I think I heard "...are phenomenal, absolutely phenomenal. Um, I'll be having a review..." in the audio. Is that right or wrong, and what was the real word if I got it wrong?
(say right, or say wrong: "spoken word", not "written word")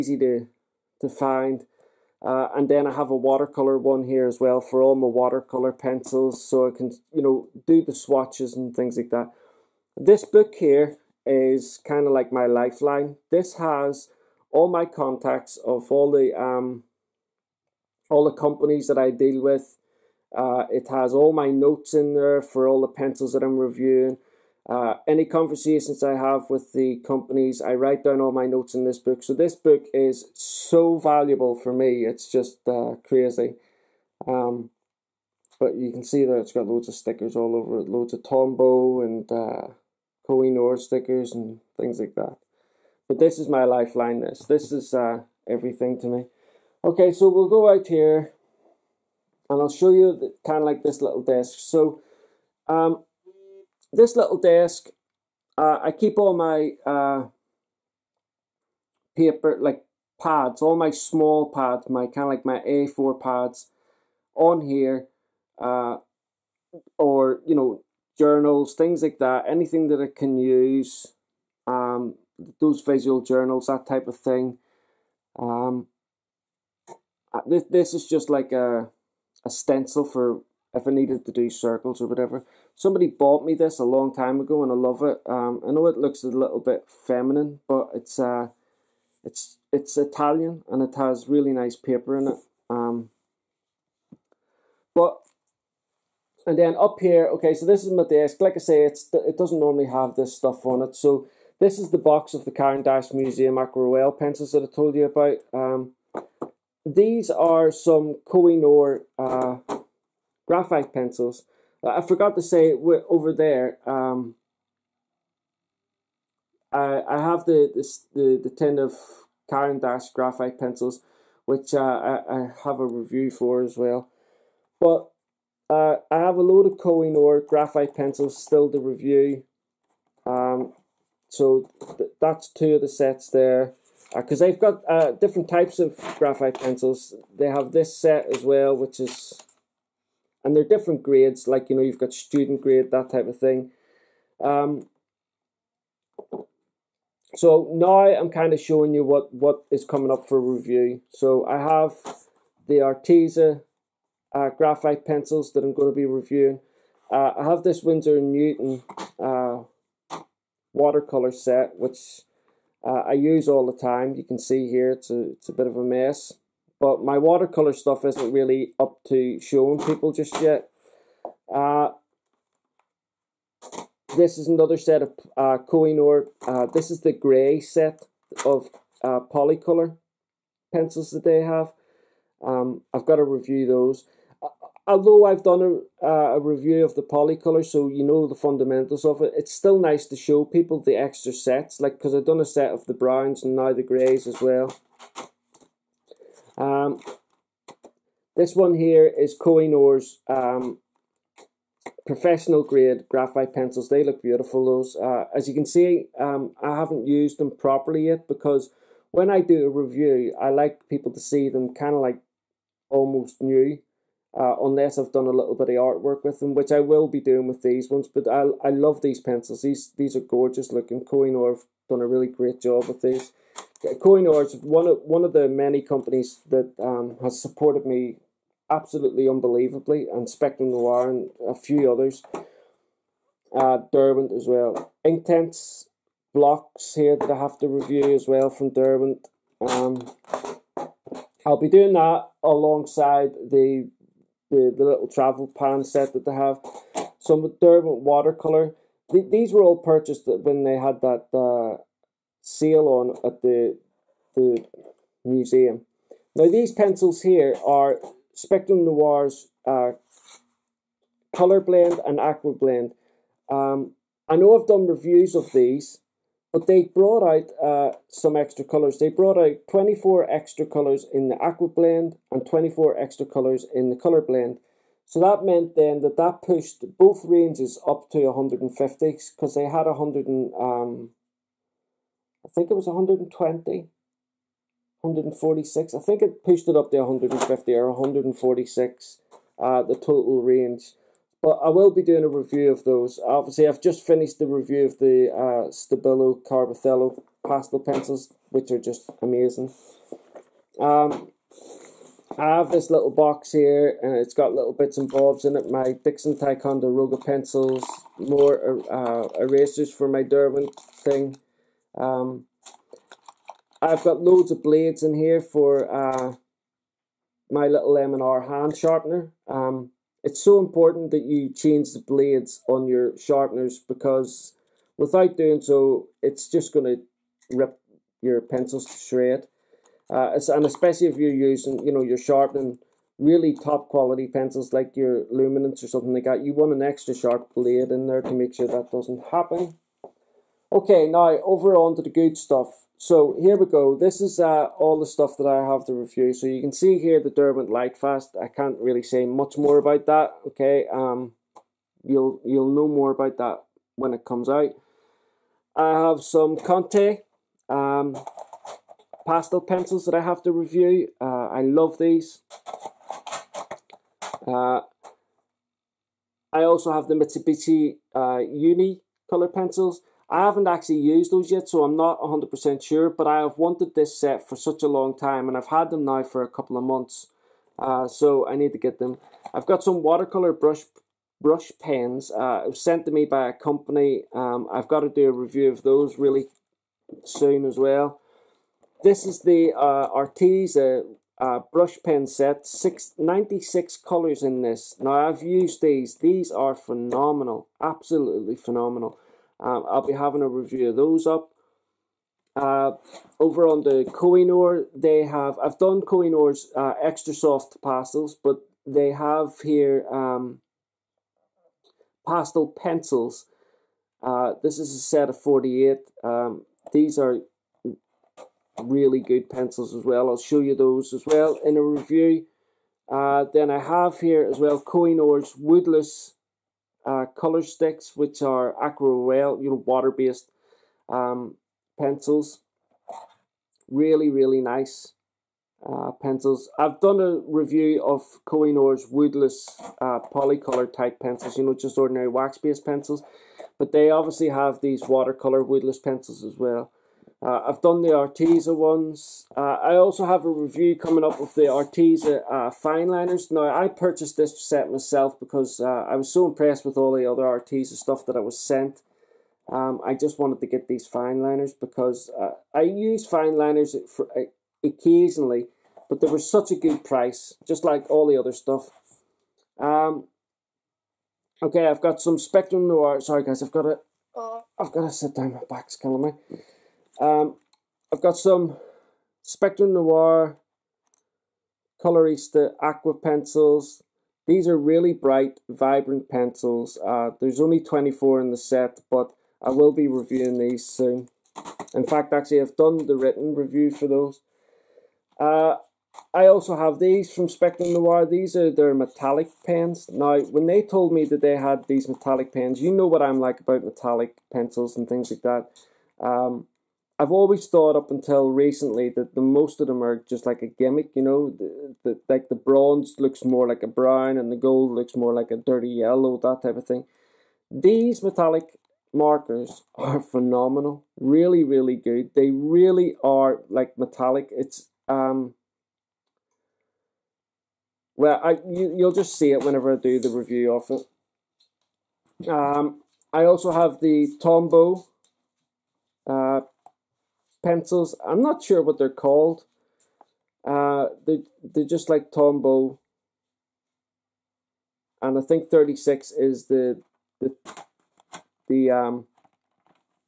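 right.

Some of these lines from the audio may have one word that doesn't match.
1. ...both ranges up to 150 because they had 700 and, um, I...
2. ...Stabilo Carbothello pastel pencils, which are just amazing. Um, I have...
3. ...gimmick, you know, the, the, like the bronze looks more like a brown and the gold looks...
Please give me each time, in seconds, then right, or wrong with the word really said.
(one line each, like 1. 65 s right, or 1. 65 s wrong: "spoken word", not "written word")
1. 276 s wrong: "100", not "700"
2. 295 s right
3. 510 s right.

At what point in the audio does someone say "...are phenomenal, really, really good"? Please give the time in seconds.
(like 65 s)
519 s.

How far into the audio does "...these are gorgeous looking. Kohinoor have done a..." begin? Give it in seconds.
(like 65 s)
219 s.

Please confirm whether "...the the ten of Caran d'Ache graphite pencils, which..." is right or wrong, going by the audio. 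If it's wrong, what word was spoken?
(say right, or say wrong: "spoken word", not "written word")
right.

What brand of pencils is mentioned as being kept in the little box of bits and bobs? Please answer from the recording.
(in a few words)
Dixon Ticonderoga.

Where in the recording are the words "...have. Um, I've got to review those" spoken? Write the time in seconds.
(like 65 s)
181 s.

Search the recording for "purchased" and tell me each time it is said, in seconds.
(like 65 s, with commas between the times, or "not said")
249 s, 453 s.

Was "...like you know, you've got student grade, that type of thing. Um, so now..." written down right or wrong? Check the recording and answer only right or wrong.
right.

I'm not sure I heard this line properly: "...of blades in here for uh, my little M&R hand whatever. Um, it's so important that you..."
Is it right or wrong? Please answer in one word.
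wrong.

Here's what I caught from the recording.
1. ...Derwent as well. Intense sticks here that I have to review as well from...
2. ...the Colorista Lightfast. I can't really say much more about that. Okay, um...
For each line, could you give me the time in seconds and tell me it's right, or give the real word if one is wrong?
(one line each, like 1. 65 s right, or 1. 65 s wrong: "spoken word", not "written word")
1. 233 s wrong: "blocks", not "sticks"
2. 347 s wrong: "Derwent", not "Colorista".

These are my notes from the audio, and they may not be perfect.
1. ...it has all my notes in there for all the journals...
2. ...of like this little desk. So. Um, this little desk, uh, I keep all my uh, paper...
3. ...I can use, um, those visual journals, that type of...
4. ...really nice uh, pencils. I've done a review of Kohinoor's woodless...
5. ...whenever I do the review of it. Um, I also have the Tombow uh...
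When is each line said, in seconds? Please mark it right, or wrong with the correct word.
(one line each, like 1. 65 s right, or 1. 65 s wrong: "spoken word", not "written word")
1. 20 s wrong: "pencils", not "journals"
2. 50 s right
3. 69 s right
4. 434 s right
5. 529 s right.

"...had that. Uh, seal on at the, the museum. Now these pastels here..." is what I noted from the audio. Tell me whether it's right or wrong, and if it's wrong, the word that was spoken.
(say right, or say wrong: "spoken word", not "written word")
wrong: "pencils", not "pastels".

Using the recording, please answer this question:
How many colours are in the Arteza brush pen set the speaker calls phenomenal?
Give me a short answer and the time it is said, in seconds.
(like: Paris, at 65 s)
96, at 393 s.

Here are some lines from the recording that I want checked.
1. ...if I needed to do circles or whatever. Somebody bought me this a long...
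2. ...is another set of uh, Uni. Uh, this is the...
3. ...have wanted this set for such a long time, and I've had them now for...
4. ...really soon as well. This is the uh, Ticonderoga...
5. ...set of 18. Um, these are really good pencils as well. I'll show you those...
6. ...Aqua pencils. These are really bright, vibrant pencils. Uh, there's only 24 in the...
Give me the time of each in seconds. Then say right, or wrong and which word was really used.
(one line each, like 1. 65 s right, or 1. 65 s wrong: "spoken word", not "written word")
1. 80 s right
2. 174 s wrong: "Kohinoor", not "Uni"
3. 373 s right
4. 386 s wrong: "Arteza", not "Ticonderoga"
5. 414 s wrong: "48", not "18"
6. 482 s right.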